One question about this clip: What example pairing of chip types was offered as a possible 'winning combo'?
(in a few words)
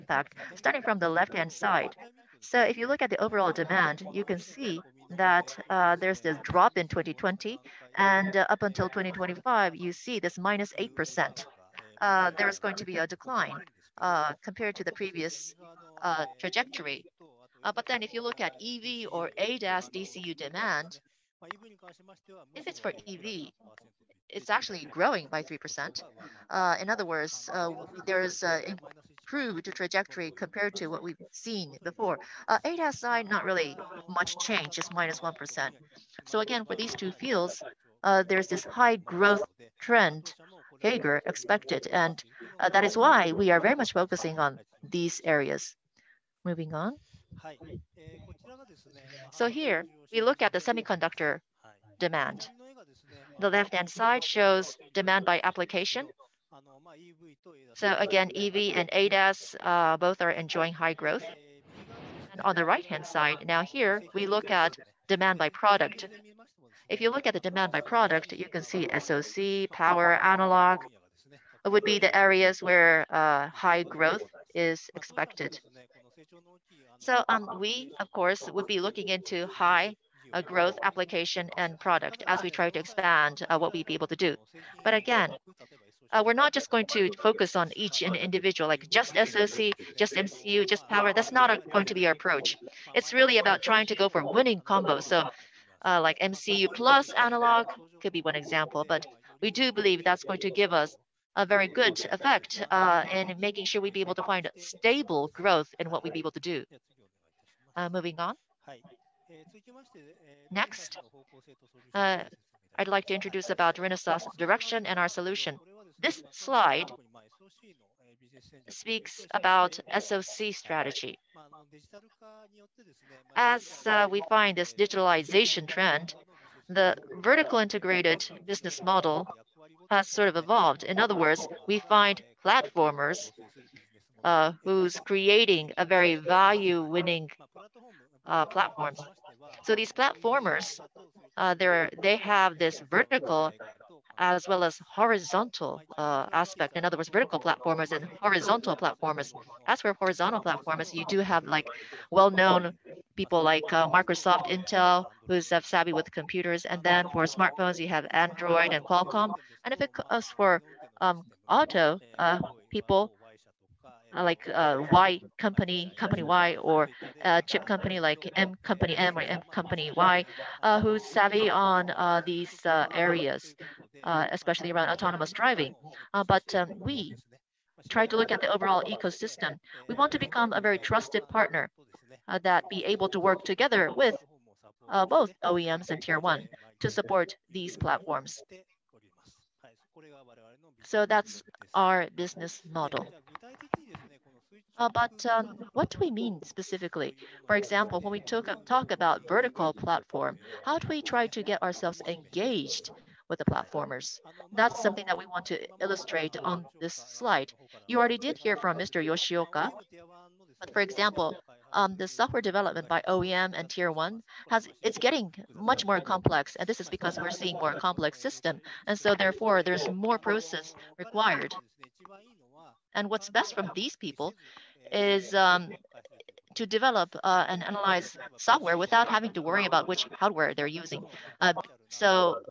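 MCU plus analog.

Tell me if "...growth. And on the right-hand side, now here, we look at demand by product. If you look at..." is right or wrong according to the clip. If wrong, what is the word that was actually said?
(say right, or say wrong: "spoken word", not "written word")
right.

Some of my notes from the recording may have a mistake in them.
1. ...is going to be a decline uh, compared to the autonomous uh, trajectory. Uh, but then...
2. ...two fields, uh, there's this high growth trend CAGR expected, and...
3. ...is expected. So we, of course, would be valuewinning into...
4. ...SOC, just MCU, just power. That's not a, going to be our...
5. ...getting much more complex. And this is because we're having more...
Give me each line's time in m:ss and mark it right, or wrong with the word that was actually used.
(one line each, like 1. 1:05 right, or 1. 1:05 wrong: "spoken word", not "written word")
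1. 0:12 wrong: "previous", not "autonomous"
2. 0:36 right
3. 1:14 wrong: "looking", not "valuewinning"
4. 1:29 right
5. 3:34 wrong: "seeing", not "having".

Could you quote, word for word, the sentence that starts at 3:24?
That's something that we want to illustrate on this slide.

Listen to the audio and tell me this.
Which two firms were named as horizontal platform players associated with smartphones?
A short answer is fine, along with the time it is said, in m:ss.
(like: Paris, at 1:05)
Android and Qualcomm, at 2:38.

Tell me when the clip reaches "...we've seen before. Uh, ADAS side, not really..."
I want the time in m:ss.
0:31.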